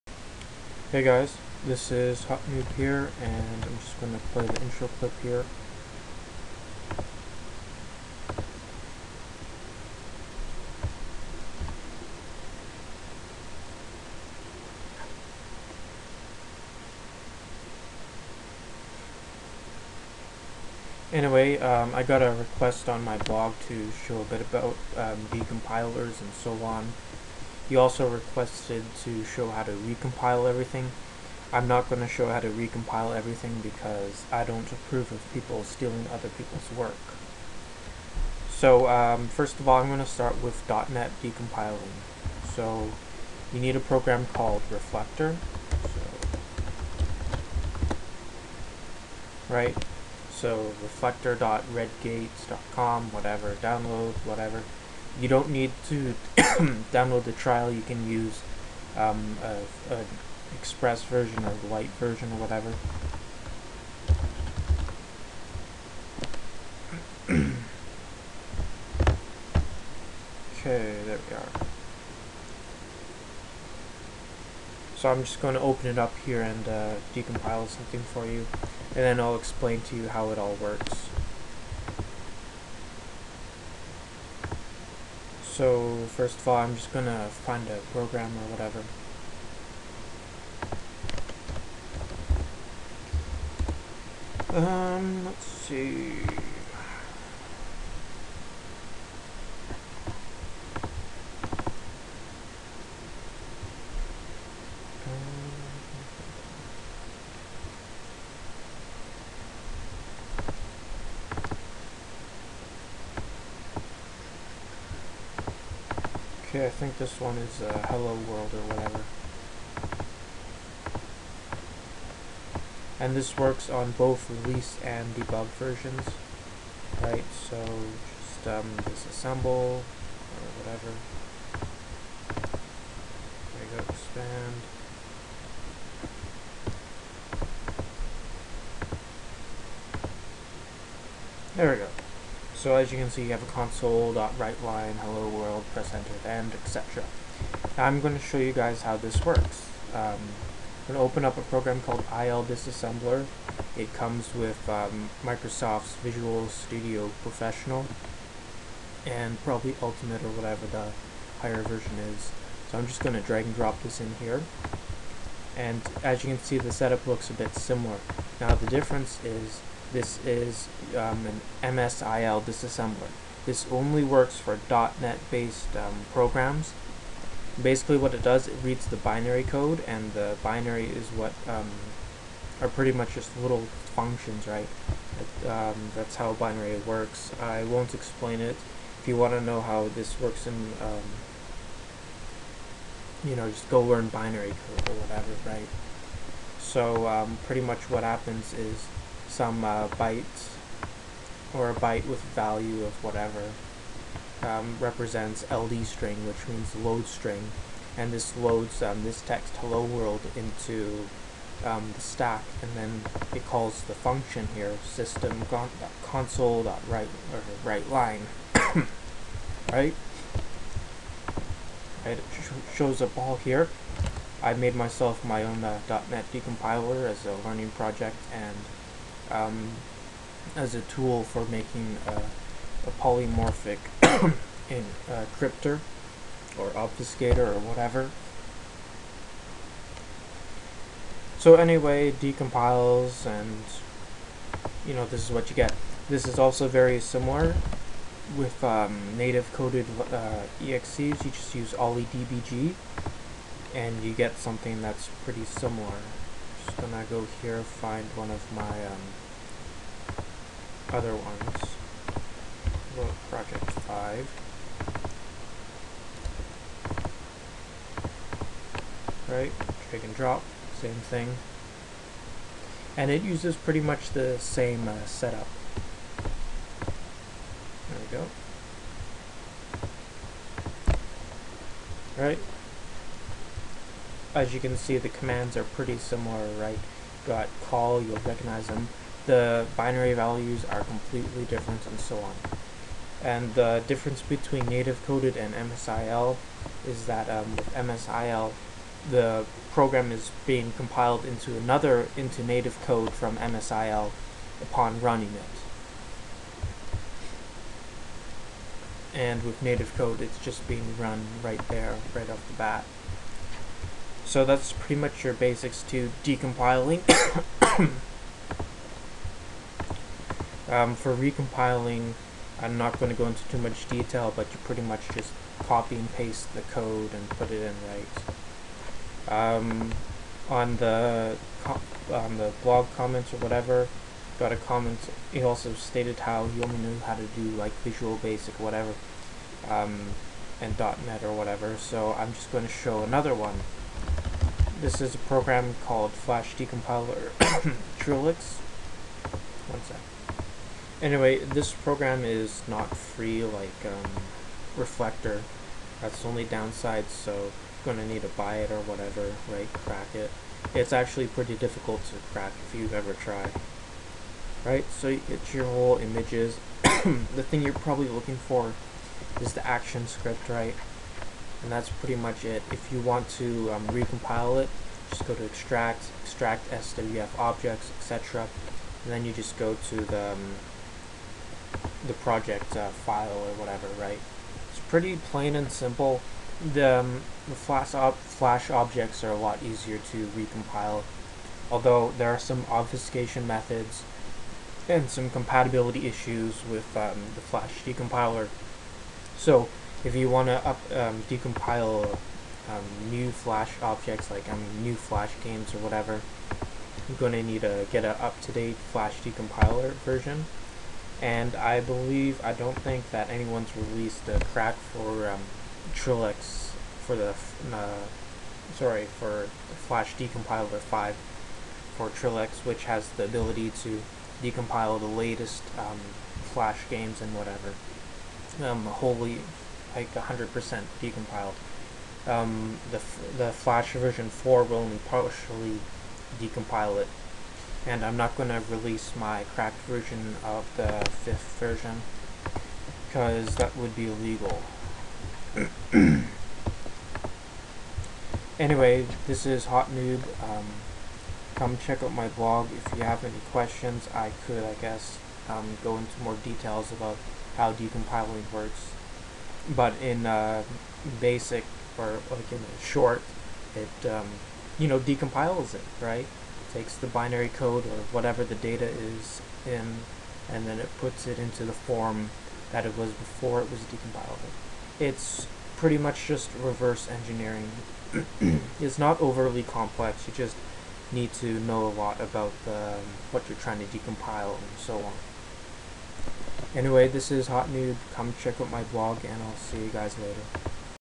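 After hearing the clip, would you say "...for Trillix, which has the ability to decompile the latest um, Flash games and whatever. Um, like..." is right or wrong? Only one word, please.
right.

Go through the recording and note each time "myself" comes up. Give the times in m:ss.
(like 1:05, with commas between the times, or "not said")
3:44.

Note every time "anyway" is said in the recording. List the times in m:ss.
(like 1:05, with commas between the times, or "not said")
0:21, 4:01, 5:51, 7:28, 8:06.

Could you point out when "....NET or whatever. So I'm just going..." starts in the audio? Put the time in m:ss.
5:40.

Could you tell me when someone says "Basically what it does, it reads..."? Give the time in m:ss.
2:57.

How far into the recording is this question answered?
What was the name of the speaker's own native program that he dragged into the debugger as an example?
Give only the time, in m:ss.
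4:23.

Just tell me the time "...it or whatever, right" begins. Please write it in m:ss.
5:58.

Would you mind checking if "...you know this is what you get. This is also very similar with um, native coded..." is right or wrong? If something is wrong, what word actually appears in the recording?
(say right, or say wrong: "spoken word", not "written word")
right.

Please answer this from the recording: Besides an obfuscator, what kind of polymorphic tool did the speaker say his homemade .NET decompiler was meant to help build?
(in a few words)
cryptor.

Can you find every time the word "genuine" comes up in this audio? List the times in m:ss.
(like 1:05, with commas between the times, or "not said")
not said.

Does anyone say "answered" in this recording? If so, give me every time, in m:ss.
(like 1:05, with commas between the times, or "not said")
not said.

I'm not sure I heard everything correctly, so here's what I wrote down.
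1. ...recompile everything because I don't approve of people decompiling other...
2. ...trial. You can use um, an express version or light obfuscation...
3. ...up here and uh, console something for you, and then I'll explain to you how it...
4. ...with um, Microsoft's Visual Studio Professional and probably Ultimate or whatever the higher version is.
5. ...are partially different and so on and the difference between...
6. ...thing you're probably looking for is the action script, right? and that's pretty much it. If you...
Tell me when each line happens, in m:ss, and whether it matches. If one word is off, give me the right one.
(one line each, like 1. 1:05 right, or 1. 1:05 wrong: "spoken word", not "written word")
1. 0:32 wrong: "stealing", not "decompiling"
2. 0:57 wrong: "version", not "obfuscation"
3. 1:15 wrong: "decompile", not "console"
4. 2:34 right
5. 4:50 wrong: "completely", not "partially"
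6. 6:07 right.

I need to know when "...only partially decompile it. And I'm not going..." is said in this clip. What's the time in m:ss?
7:14.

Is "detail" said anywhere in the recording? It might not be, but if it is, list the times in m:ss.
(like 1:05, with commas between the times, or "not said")
5:23, 7:36.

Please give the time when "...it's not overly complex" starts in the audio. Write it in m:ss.
7:58.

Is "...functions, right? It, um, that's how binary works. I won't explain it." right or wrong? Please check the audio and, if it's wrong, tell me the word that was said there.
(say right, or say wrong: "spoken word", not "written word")
right.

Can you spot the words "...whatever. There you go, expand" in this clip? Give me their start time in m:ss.
2:10.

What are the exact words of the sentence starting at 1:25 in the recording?
So first of all, I'm just gonna find a program or whatever.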